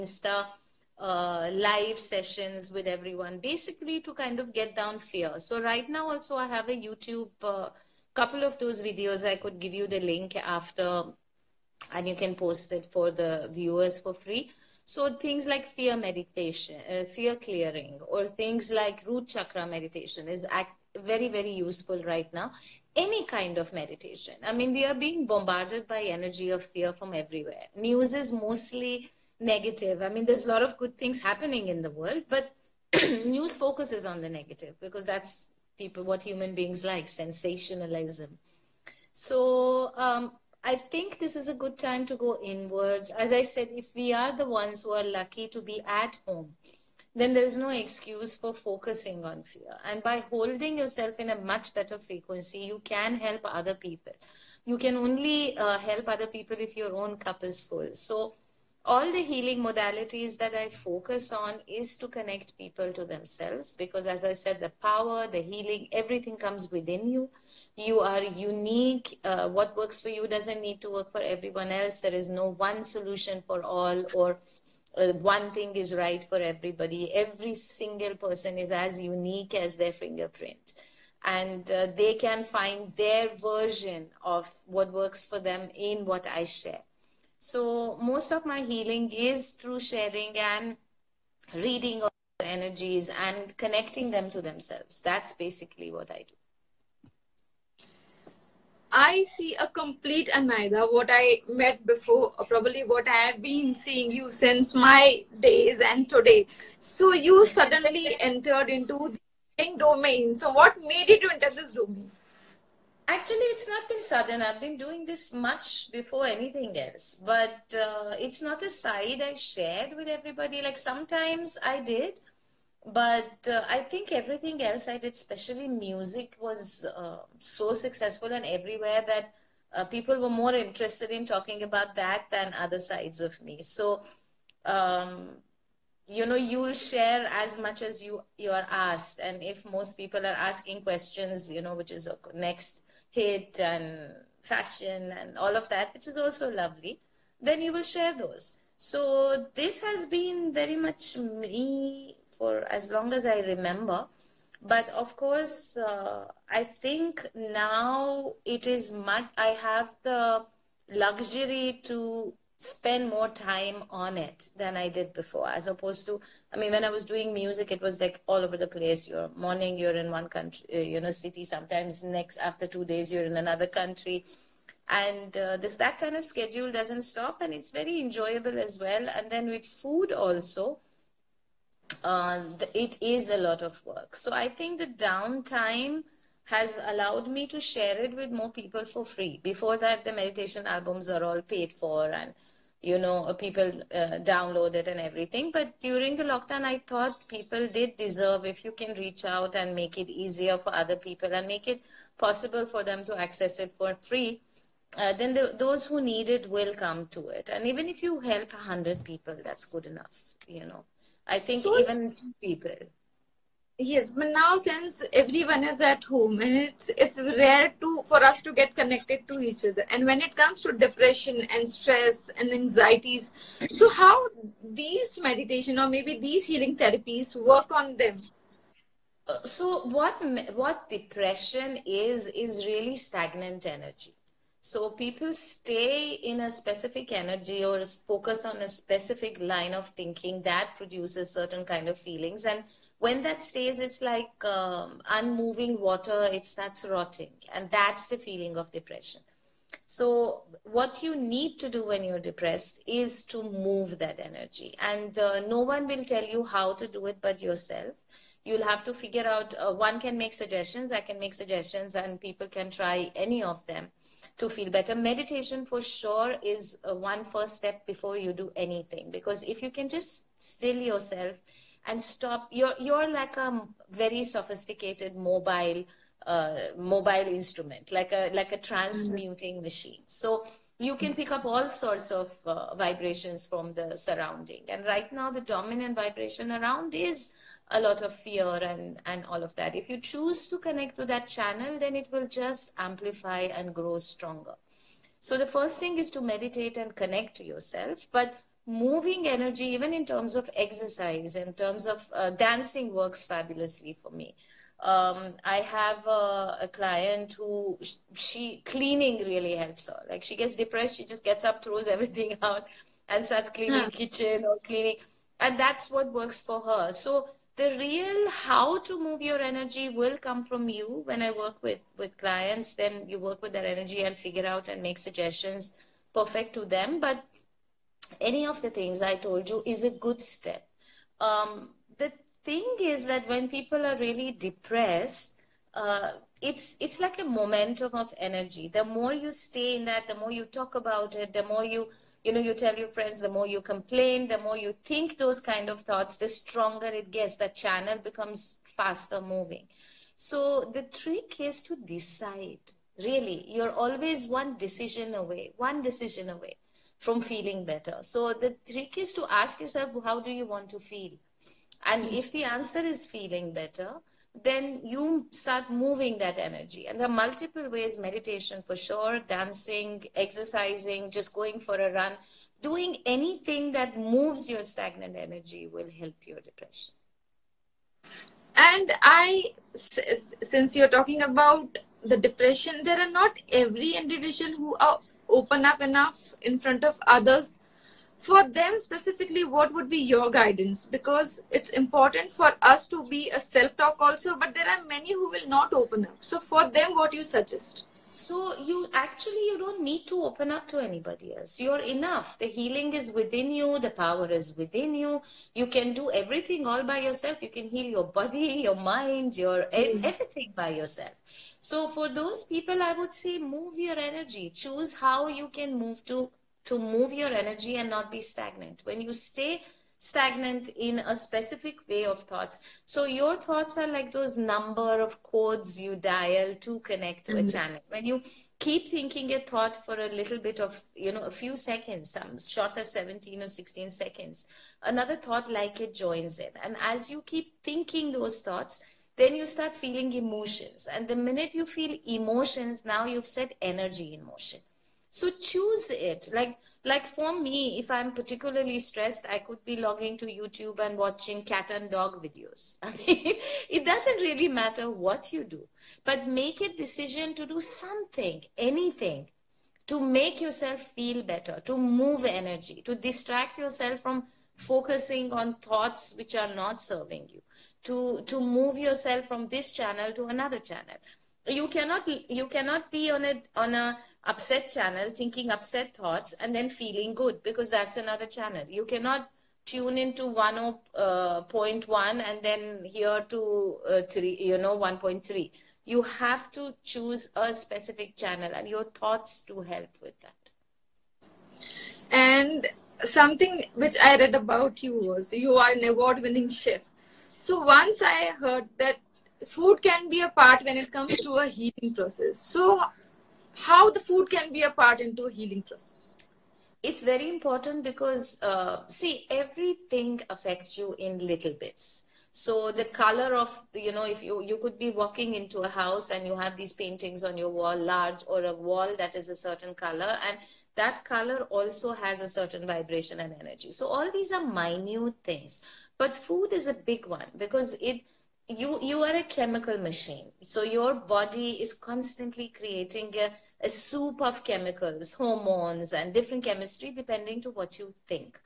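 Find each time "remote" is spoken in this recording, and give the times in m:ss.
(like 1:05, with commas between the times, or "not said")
not said.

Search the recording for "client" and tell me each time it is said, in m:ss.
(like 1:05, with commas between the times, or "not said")
5:06, 5:22.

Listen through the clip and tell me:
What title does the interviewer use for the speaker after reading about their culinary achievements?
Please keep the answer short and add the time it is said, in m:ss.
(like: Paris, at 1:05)
Award winning chef, at 8:15.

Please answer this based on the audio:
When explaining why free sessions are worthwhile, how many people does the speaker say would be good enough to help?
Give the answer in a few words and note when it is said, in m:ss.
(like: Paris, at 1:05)
100, at 3:28.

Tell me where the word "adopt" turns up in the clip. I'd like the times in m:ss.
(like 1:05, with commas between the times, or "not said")
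not said.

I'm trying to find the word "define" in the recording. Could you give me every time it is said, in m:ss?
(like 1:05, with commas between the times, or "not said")
not said.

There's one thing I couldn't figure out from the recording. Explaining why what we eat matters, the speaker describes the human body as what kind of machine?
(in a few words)
A chemical machine.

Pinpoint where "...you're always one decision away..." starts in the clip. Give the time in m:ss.
5:53.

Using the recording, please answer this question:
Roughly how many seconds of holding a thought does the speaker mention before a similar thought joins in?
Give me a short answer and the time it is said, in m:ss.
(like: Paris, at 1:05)
17 or 16 seconds, at 7:12.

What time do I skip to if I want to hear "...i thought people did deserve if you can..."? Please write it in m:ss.
3:16.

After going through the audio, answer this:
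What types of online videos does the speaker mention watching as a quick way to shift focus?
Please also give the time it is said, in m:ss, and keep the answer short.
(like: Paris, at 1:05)
Cat and dog videos, at 7:31.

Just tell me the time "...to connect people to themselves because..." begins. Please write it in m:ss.
1:01.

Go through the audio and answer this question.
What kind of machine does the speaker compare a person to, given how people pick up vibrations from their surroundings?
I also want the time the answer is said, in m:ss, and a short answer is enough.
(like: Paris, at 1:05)
A transmuting machine, at 4:38.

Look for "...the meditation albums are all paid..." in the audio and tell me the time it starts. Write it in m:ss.
3:10.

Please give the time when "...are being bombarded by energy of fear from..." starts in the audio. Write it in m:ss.
0:24.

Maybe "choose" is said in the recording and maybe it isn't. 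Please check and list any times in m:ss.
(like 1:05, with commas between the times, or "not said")
4:49, 6:54, 7:25, 8:06.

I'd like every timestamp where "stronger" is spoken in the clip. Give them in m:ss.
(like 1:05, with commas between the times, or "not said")
4:53, 5:46.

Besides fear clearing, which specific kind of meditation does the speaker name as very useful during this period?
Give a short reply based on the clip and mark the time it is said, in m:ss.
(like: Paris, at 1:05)
Root chakra meditation, at 0:19.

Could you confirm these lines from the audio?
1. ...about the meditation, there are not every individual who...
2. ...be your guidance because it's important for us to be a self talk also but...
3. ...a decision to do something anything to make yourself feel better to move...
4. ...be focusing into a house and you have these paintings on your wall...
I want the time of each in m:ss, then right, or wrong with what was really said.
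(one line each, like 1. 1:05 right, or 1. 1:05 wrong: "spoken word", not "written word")
1. 6:21 wrong: "depression", not "meditation"
2. 6:29 right
3. 7:36 right
4. 8:34 wrong: "walking", not "focusing".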